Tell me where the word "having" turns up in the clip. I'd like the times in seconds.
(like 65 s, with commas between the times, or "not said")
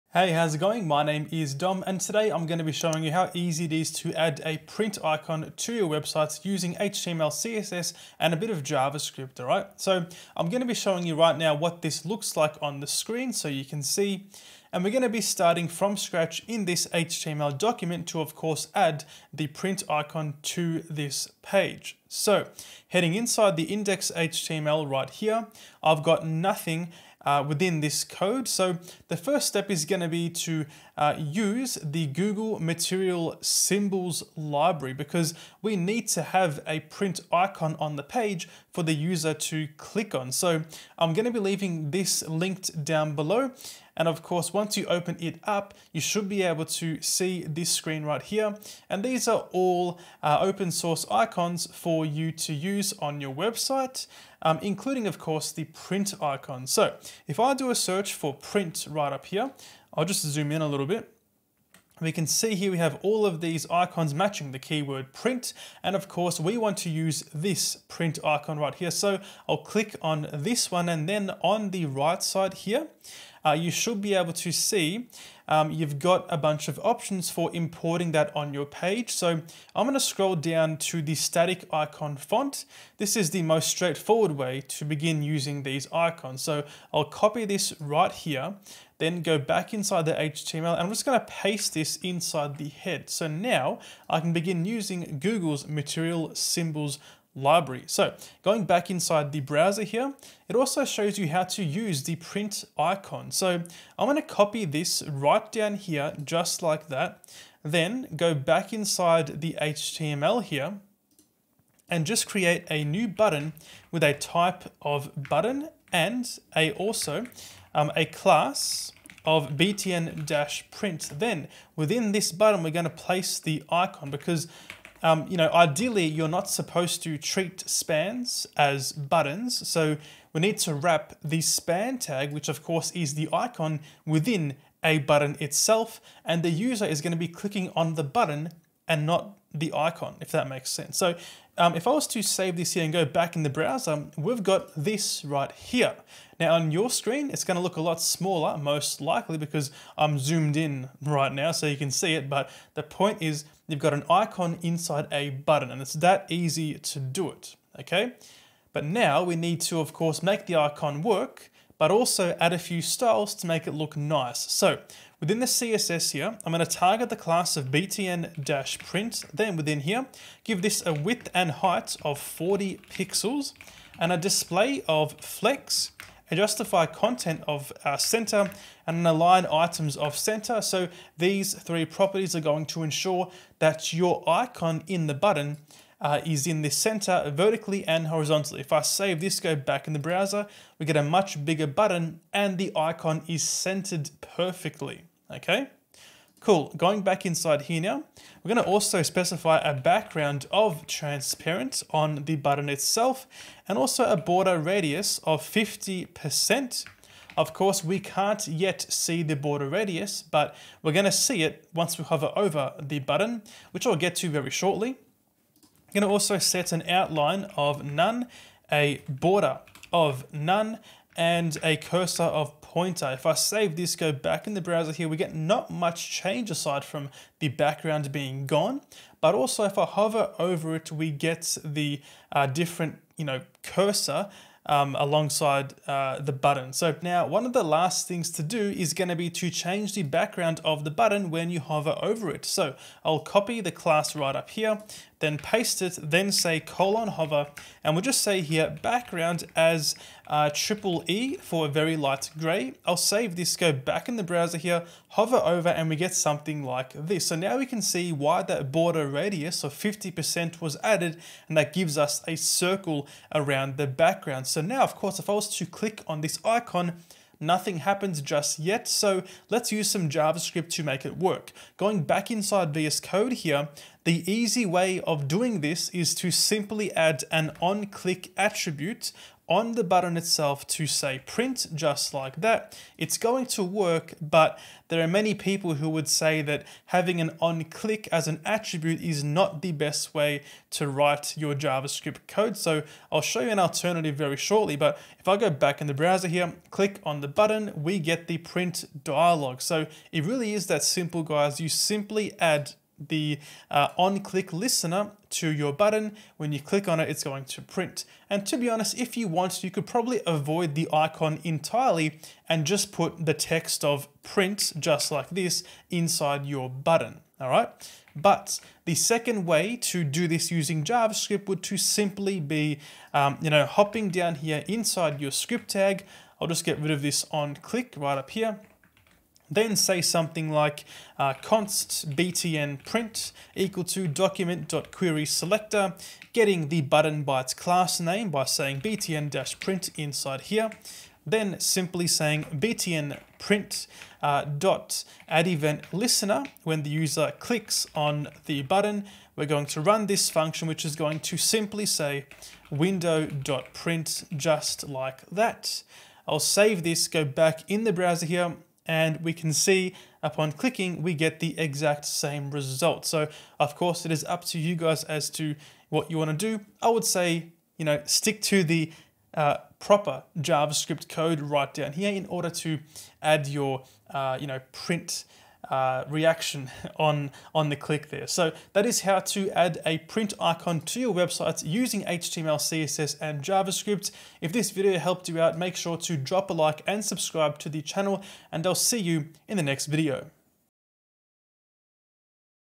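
286 s.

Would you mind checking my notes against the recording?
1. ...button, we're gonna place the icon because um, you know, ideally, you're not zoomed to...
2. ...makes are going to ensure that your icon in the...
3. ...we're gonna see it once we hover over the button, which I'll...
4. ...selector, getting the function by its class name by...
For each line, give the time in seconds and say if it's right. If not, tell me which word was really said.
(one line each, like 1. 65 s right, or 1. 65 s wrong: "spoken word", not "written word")
1. 122 s wrong: "supposed", not "zoomed"
2. 181 s wrong: "properties", not "makes"
3. 210 s right
4. 335 s wrong: "button", not "function".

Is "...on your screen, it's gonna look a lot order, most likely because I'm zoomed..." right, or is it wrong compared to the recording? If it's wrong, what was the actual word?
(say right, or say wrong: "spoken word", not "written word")
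wrong: "smaller", not "order".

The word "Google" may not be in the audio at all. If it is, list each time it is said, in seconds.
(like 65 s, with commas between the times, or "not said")
32 s, 95 s.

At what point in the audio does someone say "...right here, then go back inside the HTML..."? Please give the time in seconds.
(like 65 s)
87 s.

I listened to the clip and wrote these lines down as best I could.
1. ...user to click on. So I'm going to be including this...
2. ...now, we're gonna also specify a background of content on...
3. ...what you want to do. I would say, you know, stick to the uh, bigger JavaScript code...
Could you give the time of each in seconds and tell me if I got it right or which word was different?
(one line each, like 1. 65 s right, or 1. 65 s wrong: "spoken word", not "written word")
1. 38 s wrong: "leaving", not "including"
2. 197 s wrong: "transparent", not "content"
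3. 365 s wrong: "proper", not "bigger".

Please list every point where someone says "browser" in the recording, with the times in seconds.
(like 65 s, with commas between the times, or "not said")
99 s, 143 s, 189 s, 224 s, 254 s, 295 s, 357 s.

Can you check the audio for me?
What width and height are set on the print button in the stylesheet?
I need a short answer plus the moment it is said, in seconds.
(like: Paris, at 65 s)
40 pixels, at 172 s.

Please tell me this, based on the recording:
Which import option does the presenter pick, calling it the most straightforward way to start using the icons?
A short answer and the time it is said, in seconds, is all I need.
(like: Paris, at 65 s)
static icon font, at 81 s.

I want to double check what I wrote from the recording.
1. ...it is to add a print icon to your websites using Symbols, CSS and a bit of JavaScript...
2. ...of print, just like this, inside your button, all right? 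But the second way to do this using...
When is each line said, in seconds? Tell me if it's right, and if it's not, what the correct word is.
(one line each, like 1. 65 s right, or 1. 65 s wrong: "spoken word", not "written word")
1. 3 s wrong: "HTML", not "Symbols"
2. 313 s right.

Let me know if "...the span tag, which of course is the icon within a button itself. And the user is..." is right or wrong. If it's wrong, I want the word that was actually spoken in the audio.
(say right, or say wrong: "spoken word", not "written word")
right.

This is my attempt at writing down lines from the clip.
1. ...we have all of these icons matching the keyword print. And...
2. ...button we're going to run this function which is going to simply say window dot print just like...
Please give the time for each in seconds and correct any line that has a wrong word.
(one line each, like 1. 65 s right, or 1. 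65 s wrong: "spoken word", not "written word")
1. 62 s right
2. 348 s right.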